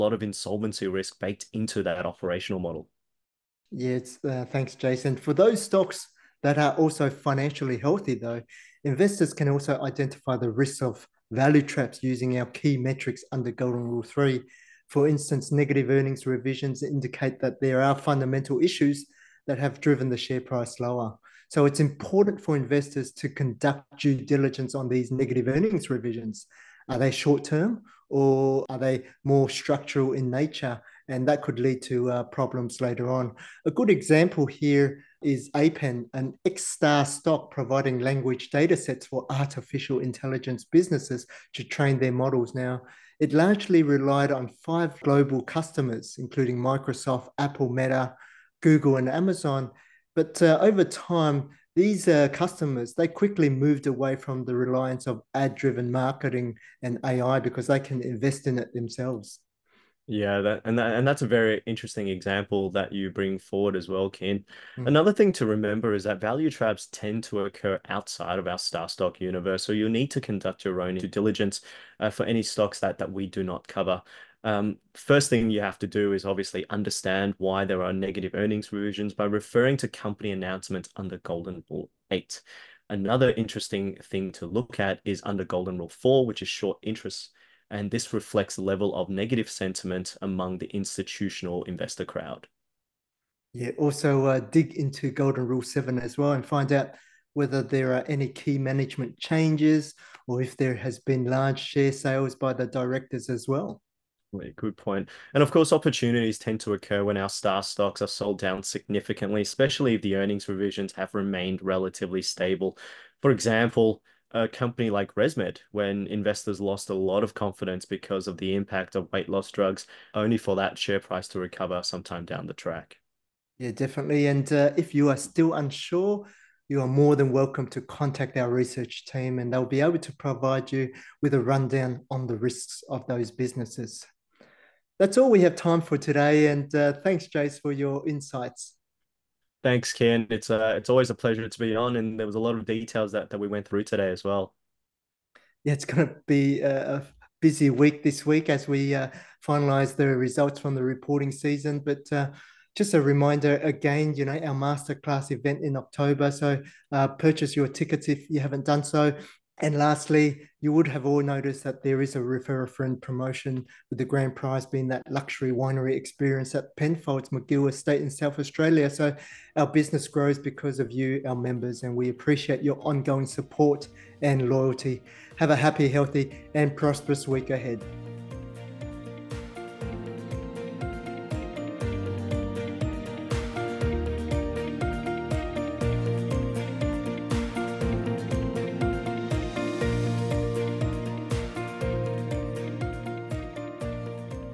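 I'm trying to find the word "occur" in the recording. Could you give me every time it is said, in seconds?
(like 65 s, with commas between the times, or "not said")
67 s, 106 s.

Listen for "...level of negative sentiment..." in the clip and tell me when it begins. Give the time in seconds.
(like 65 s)
88 s.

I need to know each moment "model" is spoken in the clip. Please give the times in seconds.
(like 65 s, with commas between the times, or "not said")
2 s, 42 s.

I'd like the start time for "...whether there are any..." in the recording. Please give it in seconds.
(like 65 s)
97 s.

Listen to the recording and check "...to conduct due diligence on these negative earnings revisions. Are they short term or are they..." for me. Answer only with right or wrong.
right.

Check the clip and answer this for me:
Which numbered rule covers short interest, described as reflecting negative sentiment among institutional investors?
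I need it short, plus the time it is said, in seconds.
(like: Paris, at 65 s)
Golden Rule 4, at 85 s.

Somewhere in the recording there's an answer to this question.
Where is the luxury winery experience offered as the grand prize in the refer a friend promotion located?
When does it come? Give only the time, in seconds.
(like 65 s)
166 s.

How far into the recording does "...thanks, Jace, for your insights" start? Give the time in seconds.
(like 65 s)
137 s.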